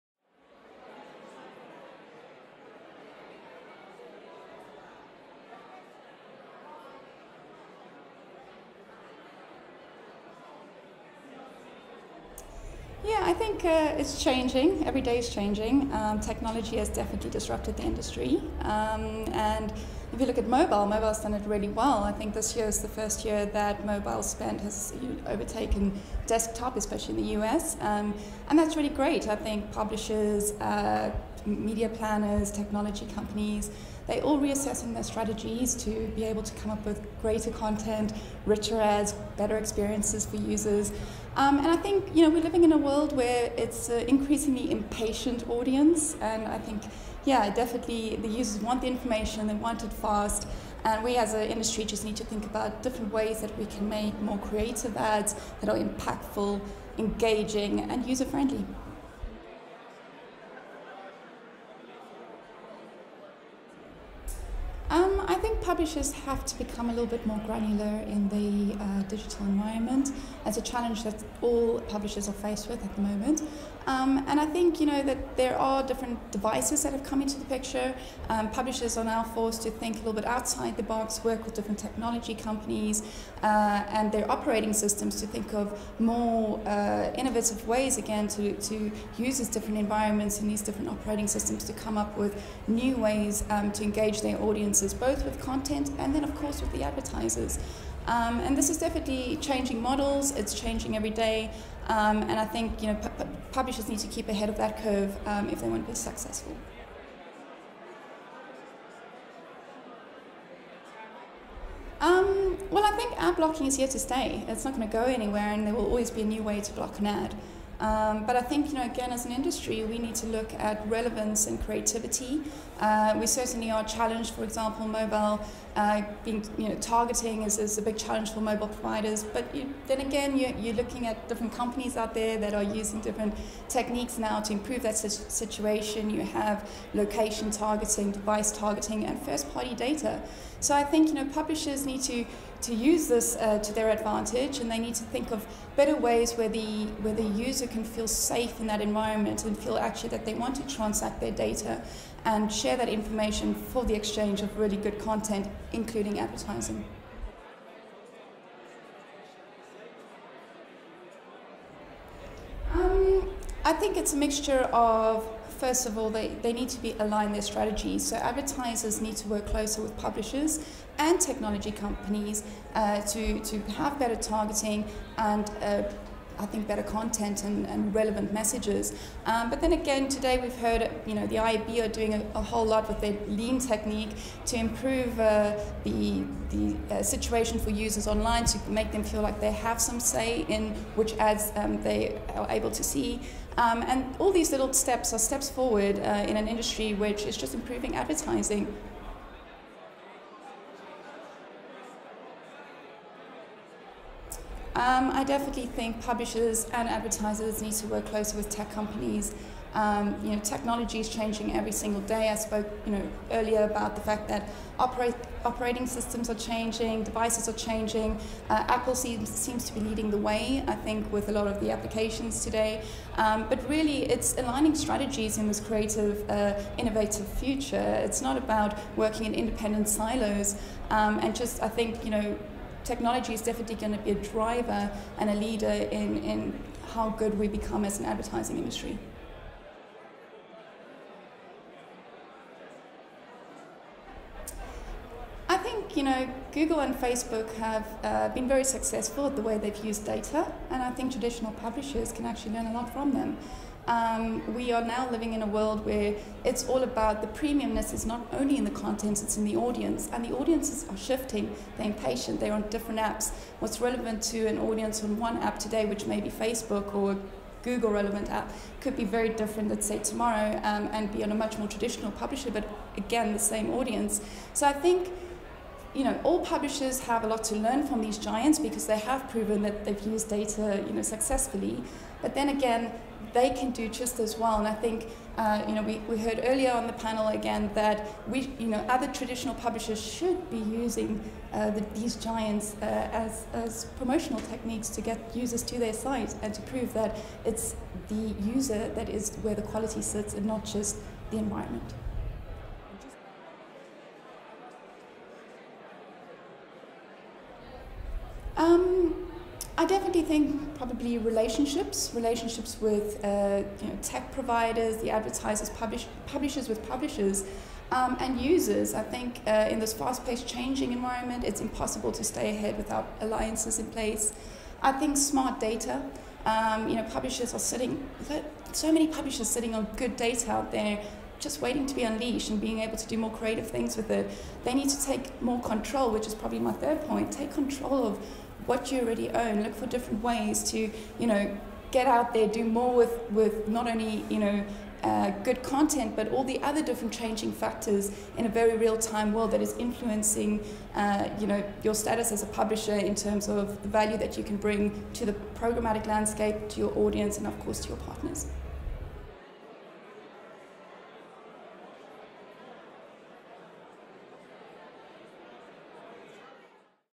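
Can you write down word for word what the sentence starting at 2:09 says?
But you, then again, you're, you're looking at different companies out there that are using different techniques now to improve that situation.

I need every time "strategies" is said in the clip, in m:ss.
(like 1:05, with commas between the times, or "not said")
0:35, 2:47, 3:44.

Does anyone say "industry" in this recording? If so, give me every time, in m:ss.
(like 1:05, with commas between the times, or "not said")
0:17, 0:51, 1:59, 3:16, 3:58.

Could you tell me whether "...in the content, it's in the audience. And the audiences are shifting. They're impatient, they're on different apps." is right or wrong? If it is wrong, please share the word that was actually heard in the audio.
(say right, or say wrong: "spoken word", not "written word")
right.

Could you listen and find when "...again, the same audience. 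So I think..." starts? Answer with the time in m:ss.
4:32.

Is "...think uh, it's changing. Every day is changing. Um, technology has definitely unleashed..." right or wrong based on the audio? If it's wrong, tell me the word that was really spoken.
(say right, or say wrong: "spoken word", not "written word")
wrong: "disrupted", not "unleashed".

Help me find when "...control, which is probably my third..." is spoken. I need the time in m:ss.
5:35.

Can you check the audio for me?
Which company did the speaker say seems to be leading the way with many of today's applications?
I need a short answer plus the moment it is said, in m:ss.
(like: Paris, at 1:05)
Apple, at 3:38.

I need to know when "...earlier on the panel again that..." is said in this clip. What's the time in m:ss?
4:46.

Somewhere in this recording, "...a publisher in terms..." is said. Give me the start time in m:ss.
5:52.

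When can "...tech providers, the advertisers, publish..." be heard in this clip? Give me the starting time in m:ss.
5:14.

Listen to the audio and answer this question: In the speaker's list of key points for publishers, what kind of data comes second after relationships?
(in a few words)
smart data.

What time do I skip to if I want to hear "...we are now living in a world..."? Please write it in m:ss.
4:14.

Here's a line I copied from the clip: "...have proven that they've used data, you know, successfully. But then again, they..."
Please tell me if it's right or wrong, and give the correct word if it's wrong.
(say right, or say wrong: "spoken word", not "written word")
right.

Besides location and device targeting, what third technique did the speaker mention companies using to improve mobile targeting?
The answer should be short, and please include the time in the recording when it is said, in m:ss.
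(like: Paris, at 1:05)
first-party data, at 2:19.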